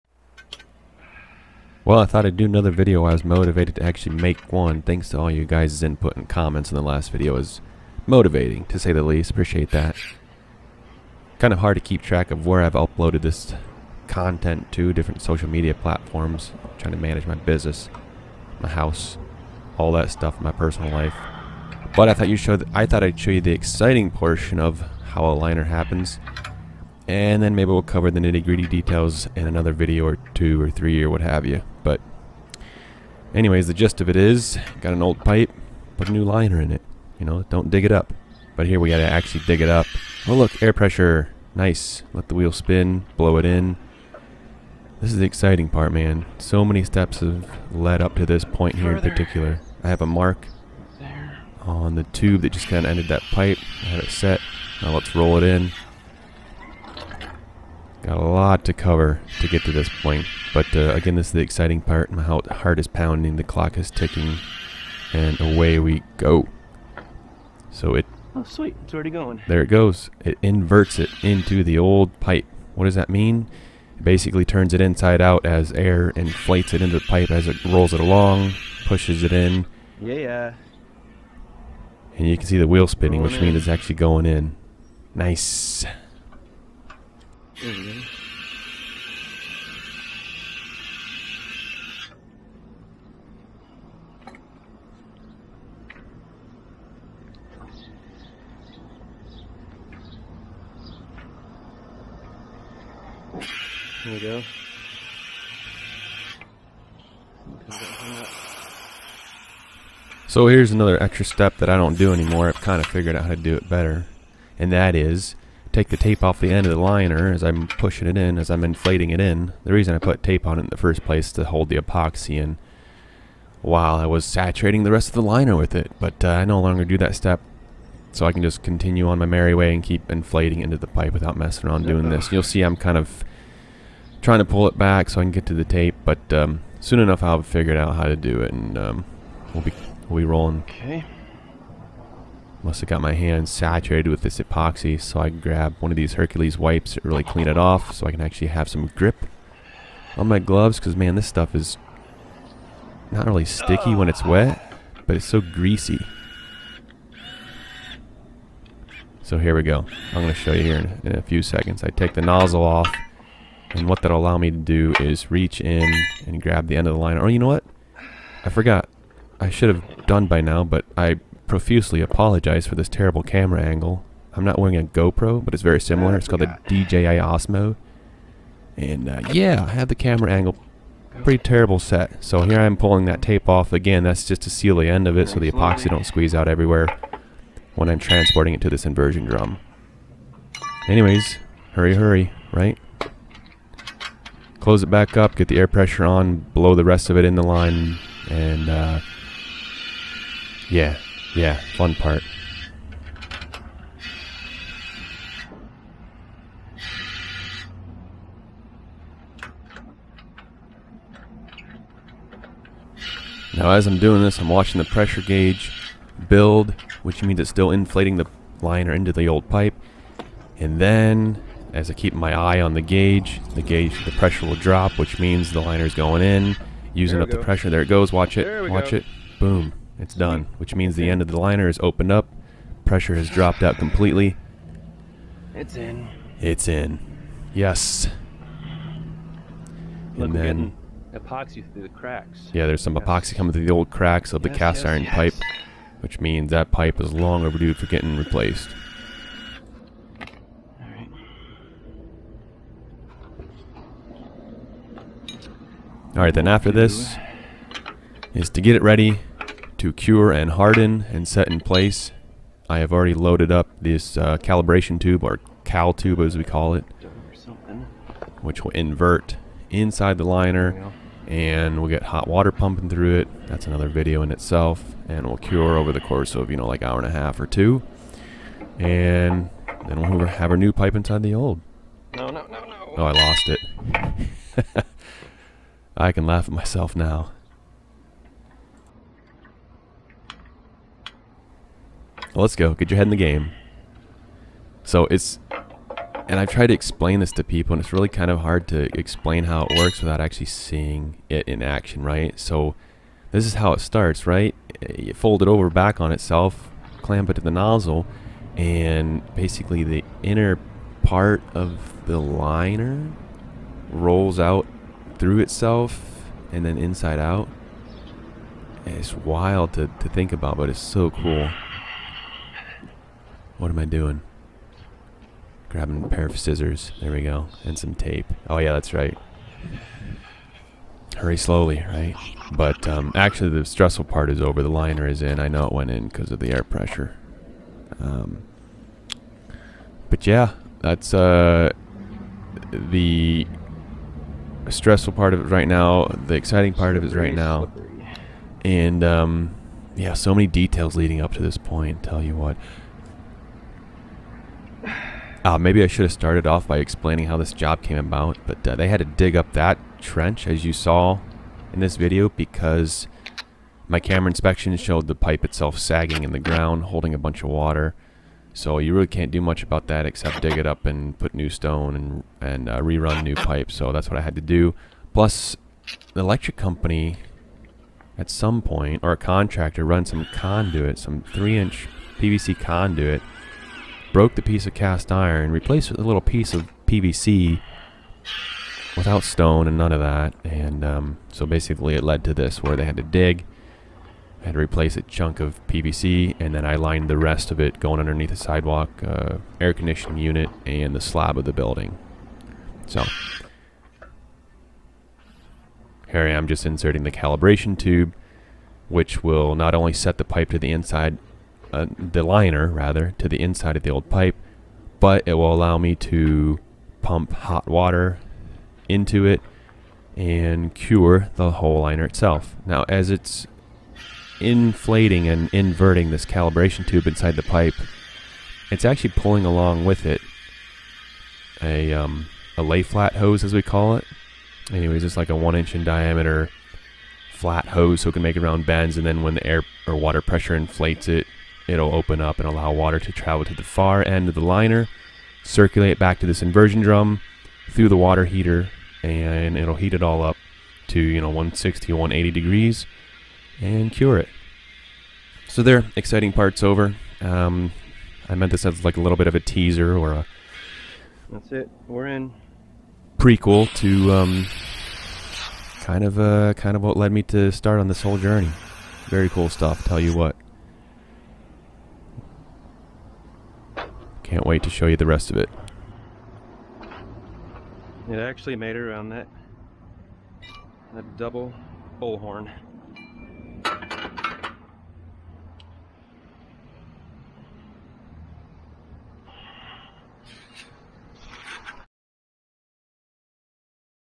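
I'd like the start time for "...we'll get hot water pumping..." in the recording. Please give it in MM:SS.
04:31.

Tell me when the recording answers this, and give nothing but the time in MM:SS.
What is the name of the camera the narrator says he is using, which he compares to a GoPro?
02:56.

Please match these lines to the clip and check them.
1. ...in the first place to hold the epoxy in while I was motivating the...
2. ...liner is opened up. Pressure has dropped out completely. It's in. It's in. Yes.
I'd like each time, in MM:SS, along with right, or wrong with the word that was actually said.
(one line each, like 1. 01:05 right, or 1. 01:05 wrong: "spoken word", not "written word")
1. 02:00 wrong: "saturating", not "motivating"
2. 03:51 right.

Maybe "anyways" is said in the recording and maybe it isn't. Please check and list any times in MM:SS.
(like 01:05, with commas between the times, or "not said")
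00:33, 03:10, 07:14.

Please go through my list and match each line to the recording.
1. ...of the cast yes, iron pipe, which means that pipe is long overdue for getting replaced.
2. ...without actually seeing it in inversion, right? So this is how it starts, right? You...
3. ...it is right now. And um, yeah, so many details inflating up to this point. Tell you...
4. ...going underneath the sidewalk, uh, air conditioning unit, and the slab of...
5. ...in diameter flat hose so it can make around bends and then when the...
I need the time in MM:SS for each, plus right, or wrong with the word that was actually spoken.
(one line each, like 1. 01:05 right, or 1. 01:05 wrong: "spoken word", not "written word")
1. 04:04 right
2. 04:59 wrong: "action", not "inversion"
3. 05:47 wrong: "leading", not "inflating"
4. 06:37 right
5. 07:15 right.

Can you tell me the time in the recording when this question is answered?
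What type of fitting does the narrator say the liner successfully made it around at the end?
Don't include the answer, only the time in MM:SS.
08:01.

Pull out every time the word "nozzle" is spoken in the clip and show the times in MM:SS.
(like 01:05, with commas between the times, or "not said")
02:42, 05:07.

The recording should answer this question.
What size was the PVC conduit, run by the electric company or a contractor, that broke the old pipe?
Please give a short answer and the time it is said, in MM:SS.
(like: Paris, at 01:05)
3-inch, at 06:21.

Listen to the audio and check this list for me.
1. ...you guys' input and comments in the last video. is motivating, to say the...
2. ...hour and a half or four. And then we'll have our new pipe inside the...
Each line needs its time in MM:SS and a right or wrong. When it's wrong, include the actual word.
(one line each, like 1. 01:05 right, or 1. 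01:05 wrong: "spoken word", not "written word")
1. 00:05 right
2. 04:36 wrong: "two", not "four".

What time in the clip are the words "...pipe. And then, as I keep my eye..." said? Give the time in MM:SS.
03:39.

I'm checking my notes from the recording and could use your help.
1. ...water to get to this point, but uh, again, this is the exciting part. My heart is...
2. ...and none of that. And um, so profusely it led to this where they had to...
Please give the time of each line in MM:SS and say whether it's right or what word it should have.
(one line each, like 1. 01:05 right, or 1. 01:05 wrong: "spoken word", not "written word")
1. 00:58 wrong: "cover", not "water"
2. 06:29 wrong: "basically", not "profusely".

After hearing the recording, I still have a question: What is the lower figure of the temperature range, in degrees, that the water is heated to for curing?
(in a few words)
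160.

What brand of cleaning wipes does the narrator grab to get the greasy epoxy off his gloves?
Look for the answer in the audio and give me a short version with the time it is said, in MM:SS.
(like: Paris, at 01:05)
Hercules, at 02:26.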